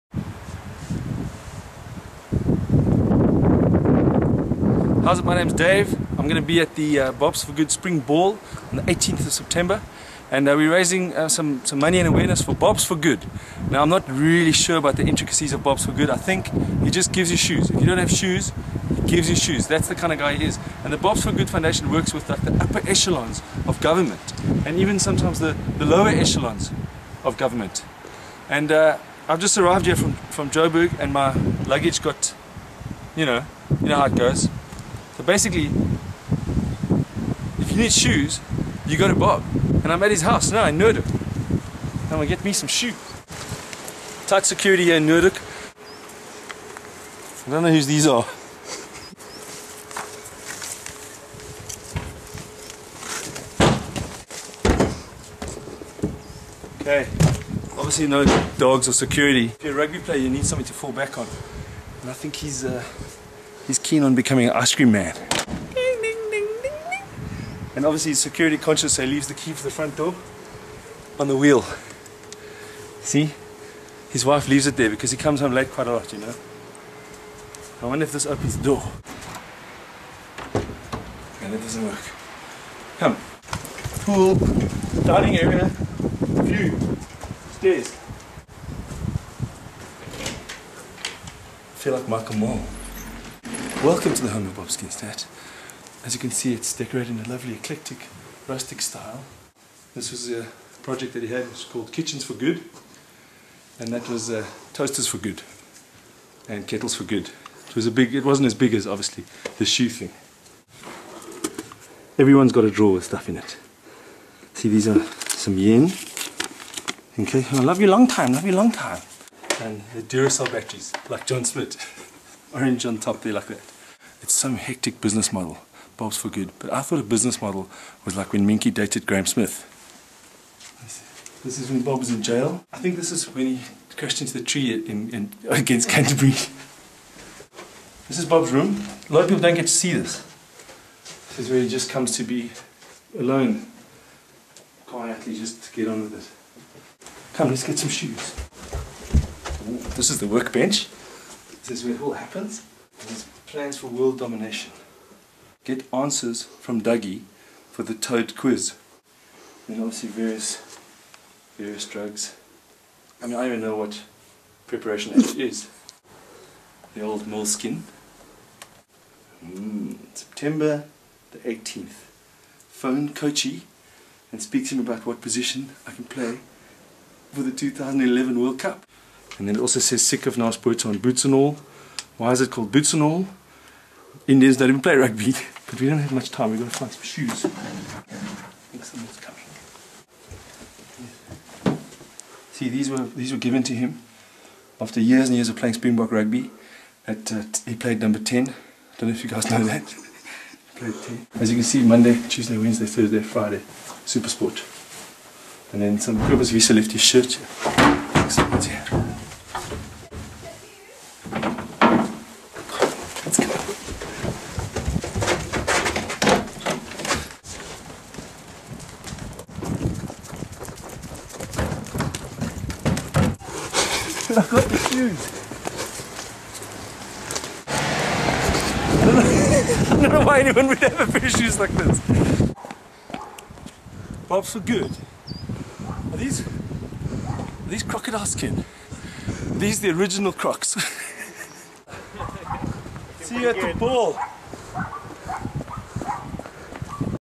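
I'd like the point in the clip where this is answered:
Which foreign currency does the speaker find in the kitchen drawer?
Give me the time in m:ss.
1:55.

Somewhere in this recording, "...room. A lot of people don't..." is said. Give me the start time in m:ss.
2:18.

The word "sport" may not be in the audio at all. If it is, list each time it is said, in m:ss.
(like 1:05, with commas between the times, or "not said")
3:24.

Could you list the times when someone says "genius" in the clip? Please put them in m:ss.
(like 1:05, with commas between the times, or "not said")
not said.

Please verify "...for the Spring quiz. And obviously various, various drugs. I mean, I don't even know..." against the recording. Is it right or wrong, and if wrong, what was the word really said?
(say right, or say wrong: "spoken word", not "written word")
wrong: "Toad", not "Spring".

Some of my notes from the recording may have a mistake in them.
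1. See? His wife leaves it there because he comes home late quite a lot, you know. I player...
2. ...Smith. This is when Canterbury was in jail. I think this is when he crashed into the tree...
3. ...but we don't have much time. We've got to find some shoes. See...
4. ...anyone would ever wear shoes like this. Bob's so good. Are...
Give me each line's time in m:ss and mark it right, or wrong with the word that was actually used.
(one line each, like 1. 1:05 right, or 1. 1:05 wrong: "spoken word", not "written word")
1. 1:13 wrong: "wonder", not "player"
2. 2:09 wrong: "Bob", not "Canterbury"
3. 3:05 right
4. 3:50 right.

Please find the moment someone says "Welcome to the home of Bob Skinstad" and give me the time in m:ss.
1:33.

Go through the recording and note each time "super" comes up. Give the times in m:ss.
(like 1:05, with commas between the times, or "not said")
3:24.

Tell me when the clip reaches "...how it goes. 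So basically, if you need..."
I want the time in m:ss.
0:33.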